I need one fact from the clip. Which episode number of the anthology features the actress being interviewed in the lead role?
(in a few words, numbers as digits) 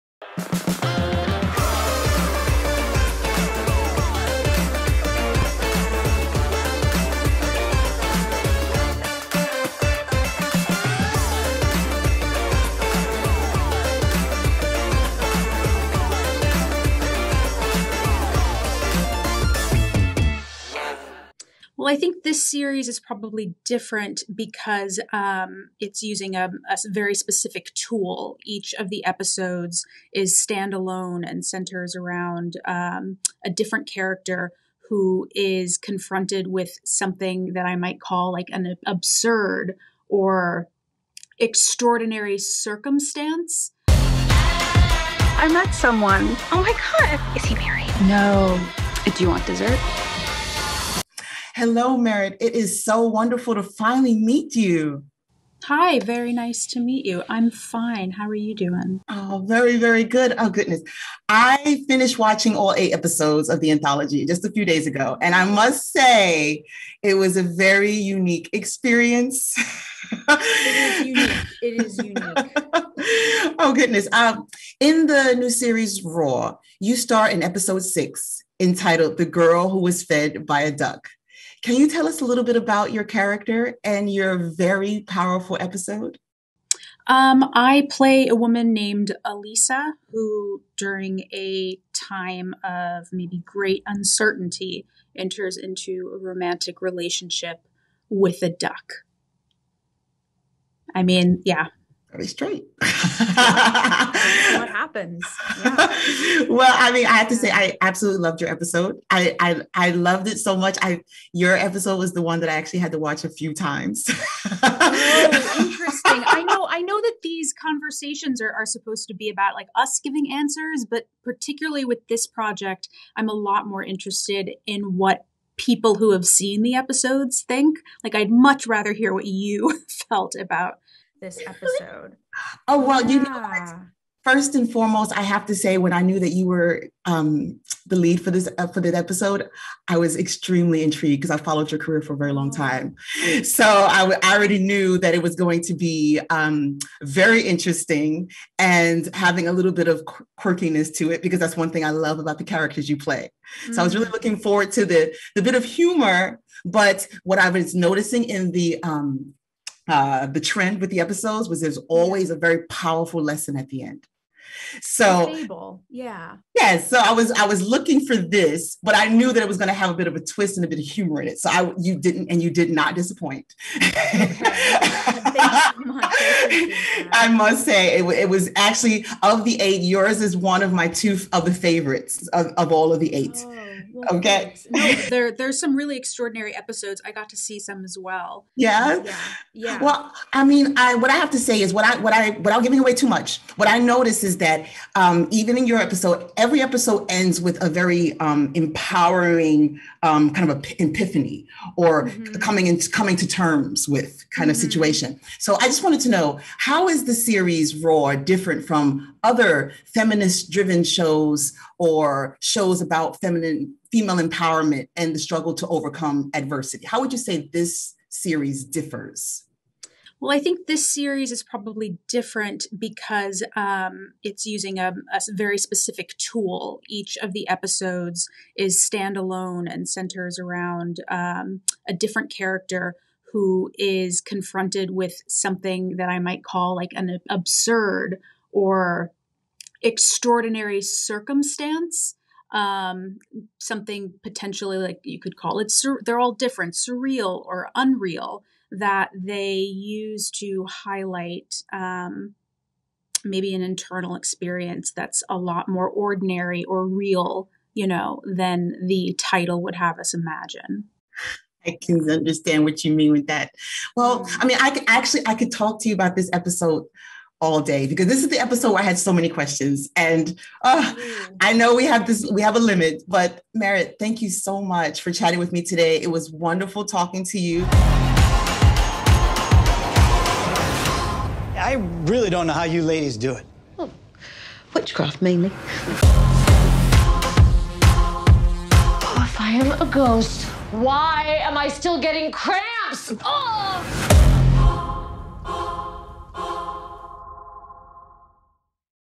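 6.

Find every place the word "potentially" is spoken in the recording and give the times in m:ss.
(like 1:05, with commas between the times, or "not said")
4:04.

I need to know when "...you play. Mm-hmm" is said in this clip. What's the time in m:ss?
2:32.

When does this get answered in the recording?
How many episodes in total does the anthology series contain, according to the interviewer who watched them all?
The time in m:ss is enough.
1:02.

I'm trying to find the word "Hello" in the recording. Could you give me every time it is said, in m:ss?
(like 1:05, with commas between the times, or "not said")
0:51.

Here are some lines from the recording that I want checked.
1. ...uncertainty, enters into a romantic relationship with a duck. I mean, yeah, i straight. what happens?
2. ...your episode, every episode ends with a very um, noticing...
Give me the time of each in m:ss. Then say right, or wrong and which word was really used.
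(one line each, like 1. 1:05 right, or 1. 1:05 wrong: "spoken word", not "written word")
1. 1:33 right
2. 3:15 wrong: "empowering", not "noticing".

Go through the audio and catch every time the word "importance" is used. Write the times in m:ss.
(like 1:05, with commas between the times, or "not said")
not said.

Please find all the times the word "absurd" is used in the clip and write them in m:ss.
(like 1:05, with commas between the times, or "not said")
0:38, 3:57.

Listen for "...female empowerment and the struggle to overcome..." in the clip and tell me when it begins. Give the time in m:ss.
3:33.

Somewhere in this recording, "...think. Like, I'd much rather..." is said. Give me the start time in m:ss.
2:07.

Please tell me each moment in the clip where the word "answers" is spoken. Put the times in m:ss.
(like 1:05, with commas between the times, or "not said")
2:00.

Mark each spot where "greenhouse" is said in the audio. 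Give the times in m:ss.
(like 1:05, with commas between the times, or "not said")
not said.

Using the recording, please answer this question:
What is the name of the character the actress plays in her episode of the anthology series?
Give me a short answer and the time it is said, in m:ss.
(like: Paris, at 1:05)
Elisa, at 1:29.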